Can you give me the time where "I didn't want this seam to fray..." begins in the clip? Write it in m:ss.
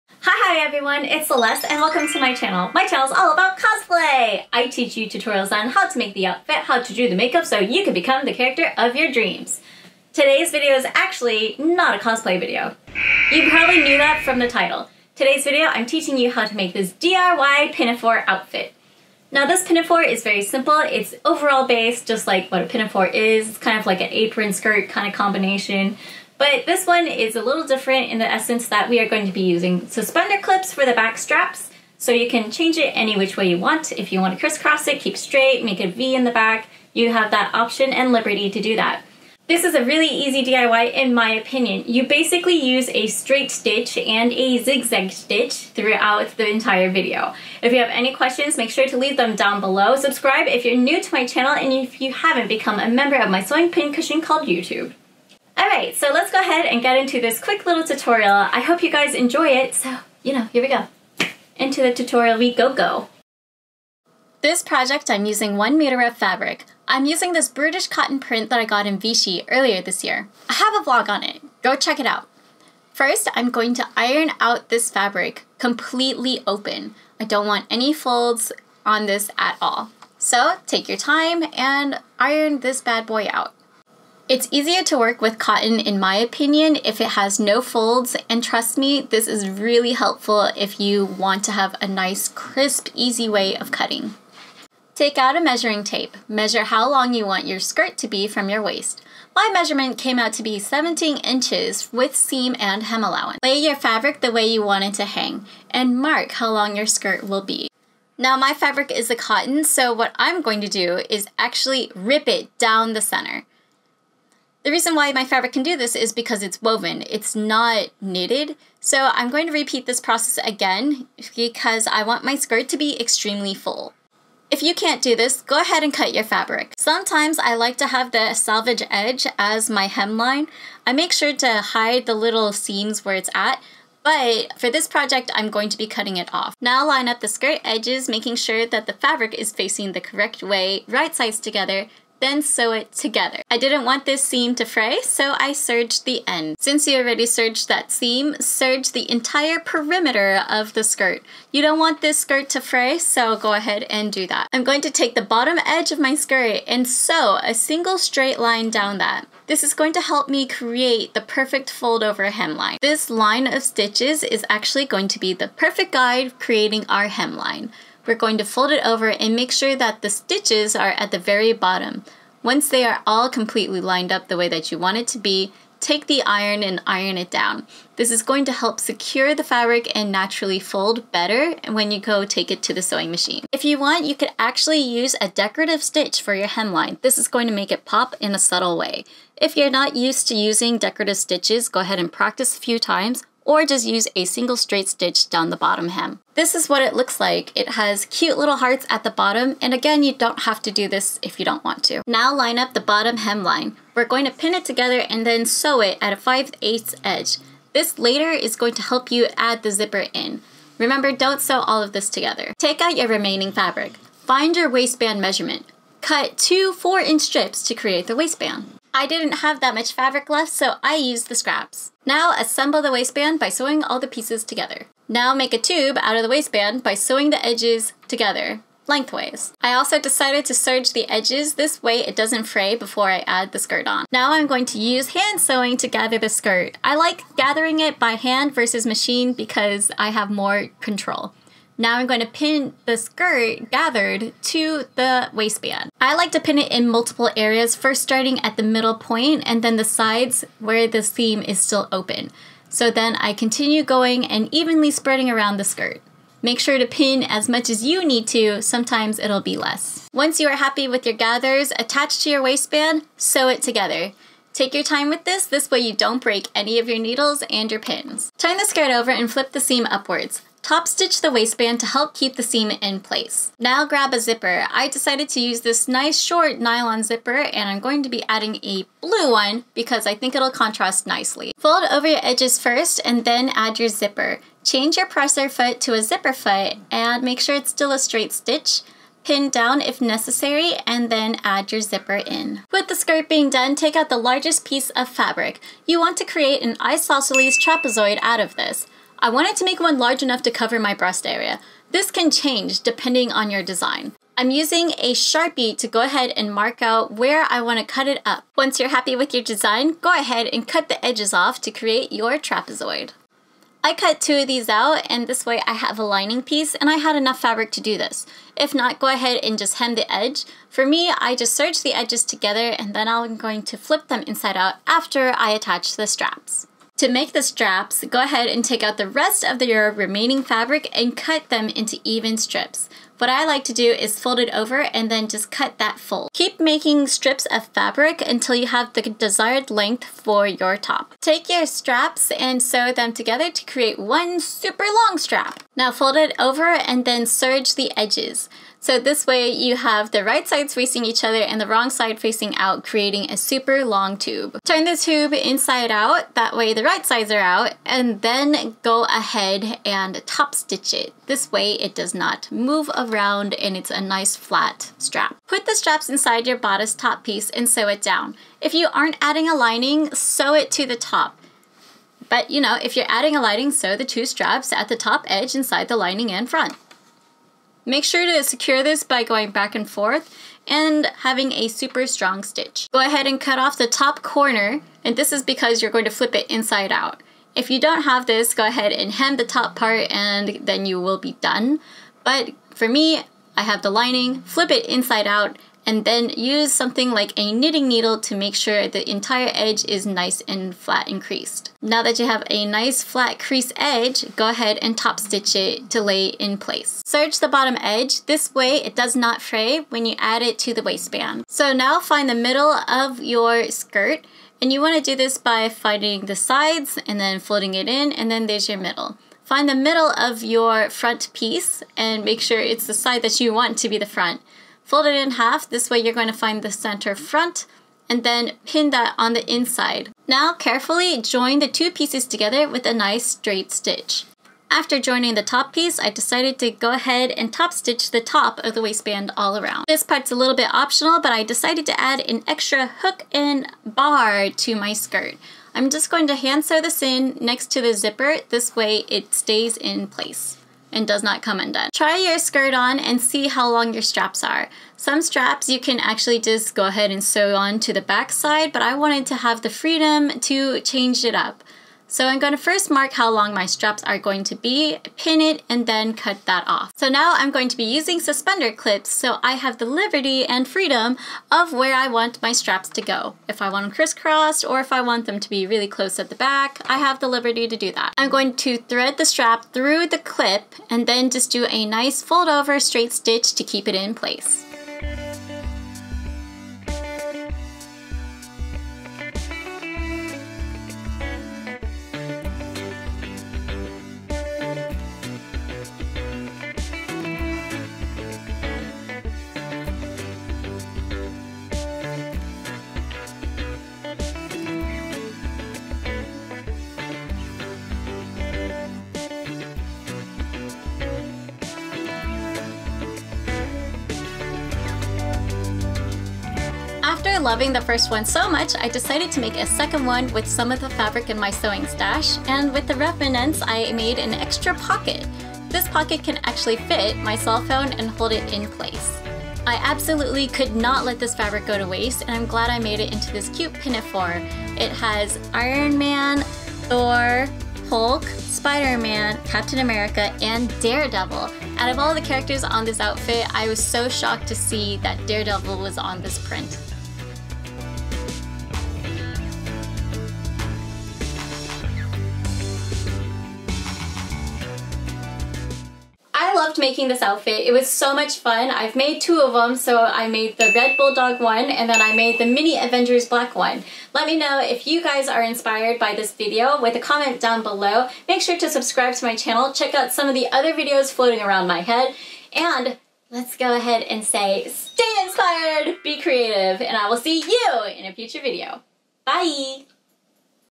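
2:23.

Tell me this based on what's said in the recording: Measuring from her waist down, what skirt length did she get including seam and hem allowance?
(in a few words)
17 inches.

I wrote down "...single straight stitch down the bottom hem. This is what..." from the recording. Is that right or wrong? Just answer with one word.
right.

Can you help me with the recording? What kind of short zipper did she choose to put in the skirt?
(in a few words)
nylon zipper.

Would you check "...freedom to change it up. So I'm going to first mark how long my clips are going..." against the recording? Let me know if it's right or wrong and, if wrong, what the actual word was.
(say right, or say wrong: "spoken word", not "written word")
wrong: "straps", not "clips".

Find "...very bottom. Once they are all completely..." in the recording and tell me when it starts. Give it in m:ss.
2:51.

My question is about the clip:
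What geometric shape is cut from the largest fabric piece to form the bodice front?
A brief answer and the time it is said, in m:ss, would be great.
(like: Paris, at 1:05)
isosceles trapezoid, at 4:56.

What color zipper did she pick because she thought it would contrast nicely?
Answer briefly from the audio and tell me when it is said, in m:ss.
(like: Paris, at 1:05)
blue, at 4:39.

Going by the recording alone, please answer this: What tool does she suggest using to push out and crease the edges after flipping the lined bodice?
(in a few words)
knitting needle.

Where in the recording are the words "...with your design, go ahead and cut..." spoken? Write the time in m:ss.
5:09.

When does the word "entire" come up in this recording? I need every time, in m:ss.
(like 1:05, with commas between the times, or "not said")
0:46, 2:29, 6:39.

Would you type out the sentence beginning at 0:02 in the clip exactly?
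My channel is all about cosplay!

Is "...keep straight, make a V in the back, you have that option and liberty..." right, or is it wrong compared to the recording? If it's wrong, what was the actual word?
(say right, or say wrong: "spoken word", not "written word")
right.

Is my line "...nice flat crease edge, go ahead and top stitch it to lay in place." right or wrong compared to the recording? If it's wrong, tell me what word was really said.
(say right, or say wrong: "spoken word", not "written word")
right.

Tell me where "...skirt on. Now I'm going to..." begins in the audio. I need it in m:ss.
3:53.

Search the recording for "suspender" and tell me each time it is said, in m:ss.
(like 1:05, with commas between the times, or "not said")
0:29, 7:48.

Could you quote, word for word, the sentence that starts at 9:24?
Let me know if you guys are inspired by this video with a comment down below.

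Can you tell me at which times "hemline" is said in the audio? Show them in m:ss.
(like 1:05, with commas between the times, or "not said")
2:09, 2:42, 2:47, 3:06, 3:23.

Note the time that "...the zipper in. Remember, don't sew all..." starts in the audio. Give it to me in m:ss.
3:29.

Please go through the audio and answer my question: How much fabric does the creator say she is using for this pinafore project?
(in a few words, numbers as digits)
1 meter.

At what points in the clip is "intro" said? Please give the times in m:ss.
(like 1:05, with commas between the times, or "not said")
not said.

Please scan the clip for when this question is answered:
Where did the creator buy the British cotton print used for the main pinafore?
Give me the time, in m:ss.
1:08.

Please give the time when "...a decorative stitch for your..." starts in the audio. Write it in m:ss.
3:05.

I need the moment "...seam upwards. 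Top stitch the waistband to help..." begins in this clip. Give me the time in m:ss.
4:29.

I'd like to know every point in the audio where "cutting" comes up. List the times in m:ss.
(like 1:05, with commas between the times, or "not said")
1:33, 2:15.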